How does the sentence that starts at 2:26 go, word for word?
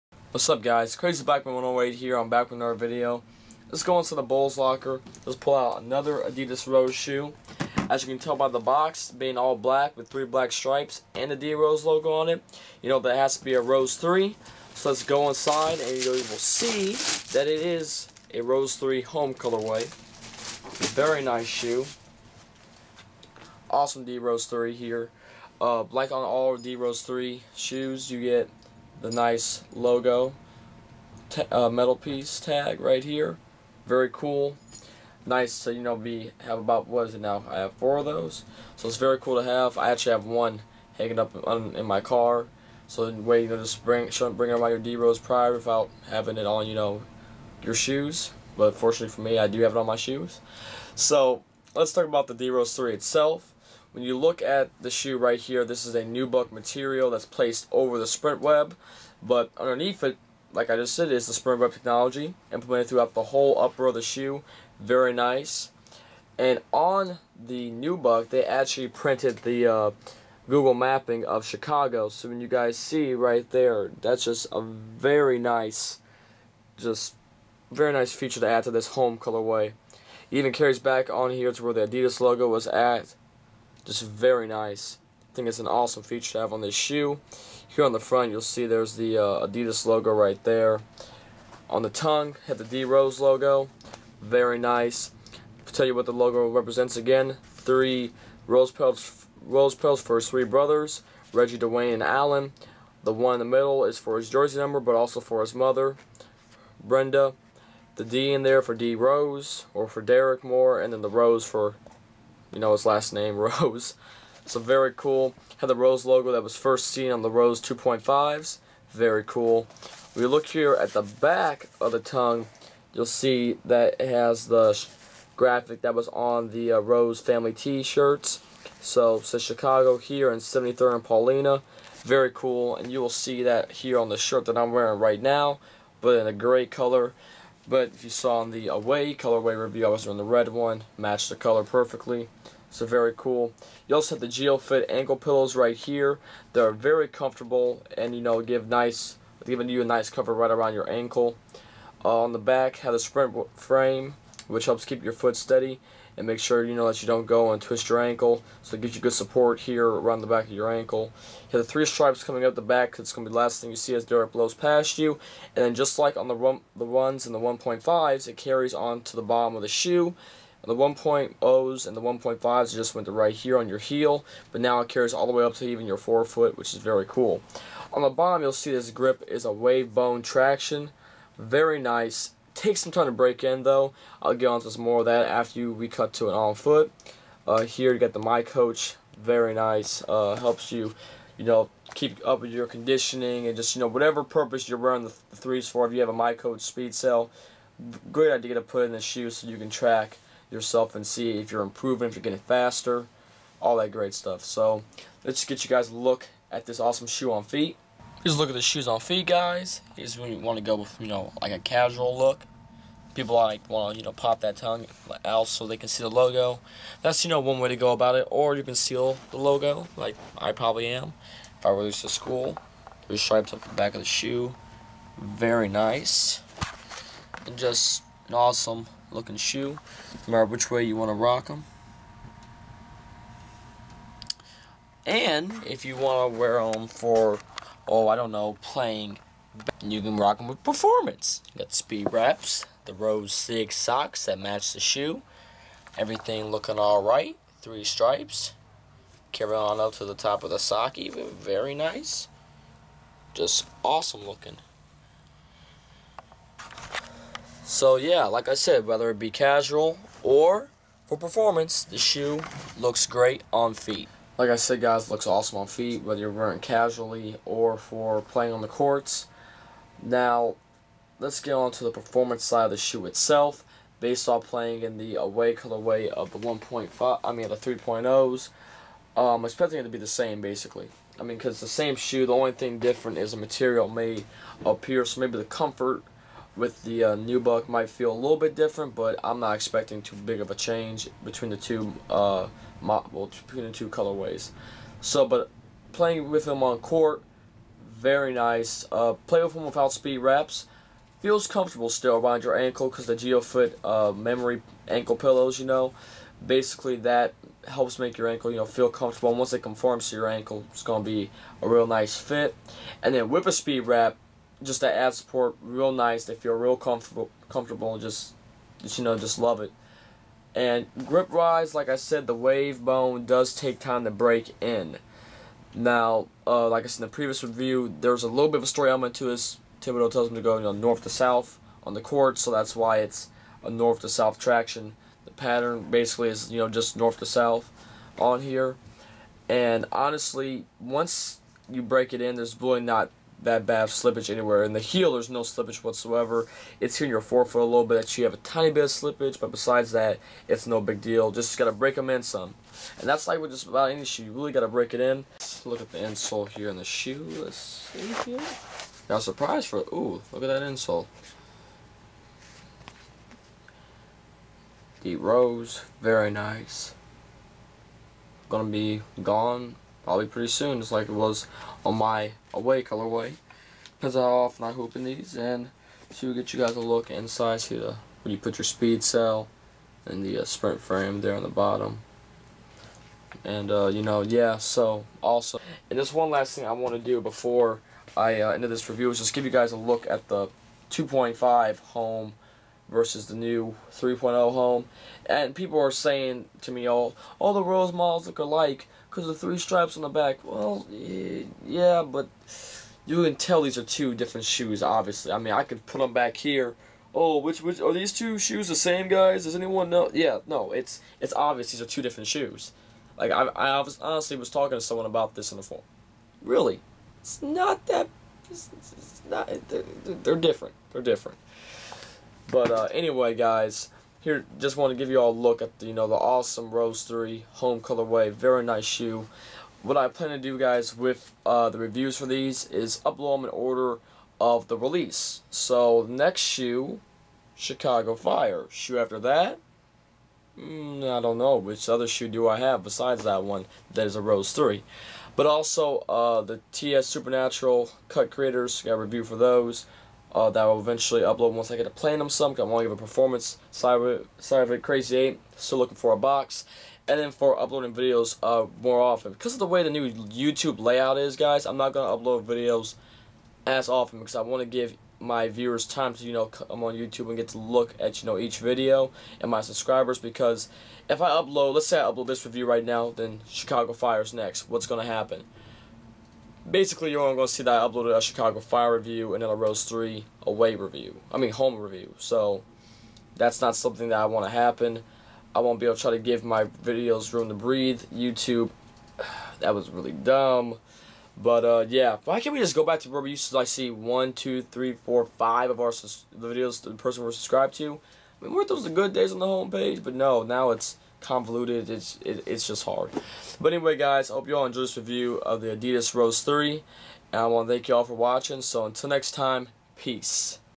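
They're very comfortable and you know give nice, giving you a nice cover right around your ankle.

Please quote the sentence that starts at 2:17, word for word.
But if you saw in the away colorway review, I was doing the red one, matched the color perfectly.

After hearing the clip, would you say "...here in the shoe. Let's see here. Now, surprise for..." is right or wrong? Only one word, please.
right.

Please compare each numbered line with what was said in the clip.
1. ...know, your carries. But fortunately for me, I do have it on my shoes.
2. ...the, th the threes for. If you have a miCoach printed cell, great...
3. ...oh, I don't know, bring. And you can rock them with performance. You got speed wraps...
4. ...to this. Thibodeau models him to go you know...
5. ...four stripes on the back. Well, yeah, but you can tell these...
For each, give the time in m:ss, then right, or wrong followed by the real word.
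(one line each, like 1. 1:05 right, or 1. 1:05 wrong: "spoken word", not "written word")
1. 0:46 wrong: "shoes", not "carries"
2. 3:15 wrong: "speed", not "printed"
3. 3:57 wrong: "playing", not "bring"
4. 5:29 wrong: "tells", not "models"
5. 6:39 wrong: "three", not "four".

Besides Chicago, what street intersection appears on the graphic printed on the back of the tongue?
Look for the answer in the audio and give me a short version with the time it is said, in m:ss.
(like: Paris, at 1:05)
73rd and Paulina, at 2:10.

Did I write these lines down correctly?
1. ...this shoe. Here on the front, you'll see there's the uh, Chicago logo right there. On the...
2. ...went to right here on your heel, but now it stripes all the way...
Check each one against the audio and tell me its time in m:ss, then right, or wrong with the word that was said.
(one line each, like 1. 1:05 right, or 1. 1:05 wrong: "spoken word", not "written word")
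1. 1:26 wrong: "Adidas", not "Chicago"
2. 2:52 wrong: "carries", not "stripes".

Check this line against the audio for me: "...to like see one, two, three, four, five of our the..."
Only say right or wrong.
right.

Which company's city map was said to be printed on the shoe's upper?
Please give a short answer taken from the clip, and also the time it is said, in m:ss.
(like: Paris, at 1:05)
Google, at 1:10.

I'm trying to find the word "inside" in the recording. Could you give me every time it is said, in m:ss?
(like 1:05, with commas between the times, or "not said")
0:15, 6:17.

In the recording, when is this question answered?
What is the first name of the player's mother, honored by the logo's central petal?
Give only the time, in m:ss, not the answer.
1:46.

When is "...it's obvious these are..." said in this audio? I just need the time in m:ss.
6:51.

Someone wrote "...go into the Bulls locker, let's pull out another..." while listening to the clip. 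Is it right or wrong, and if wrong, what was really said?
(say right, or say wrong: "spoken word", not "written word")
right.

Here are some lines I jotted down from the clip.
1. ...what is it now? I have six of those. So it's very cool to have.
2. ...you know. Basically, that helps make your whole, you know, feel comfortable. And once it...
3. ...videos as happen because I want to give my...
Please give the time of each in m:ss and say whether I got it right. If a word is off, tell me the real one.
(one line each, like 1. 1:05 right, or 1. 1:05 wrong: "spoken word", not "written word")
1. 0:36 wrong: "four", not "six"
2. 5:05 wrong: "ankle", not "whole"
3. 7:42 wrong: "often", not "happen".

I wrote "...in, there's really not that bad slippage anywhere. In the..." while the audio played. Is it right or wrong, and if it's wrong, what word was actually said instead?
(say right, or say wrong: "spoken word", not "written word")
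right.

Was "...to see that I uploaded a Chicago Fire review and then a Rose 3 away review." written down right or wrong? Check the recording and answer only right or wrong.
right.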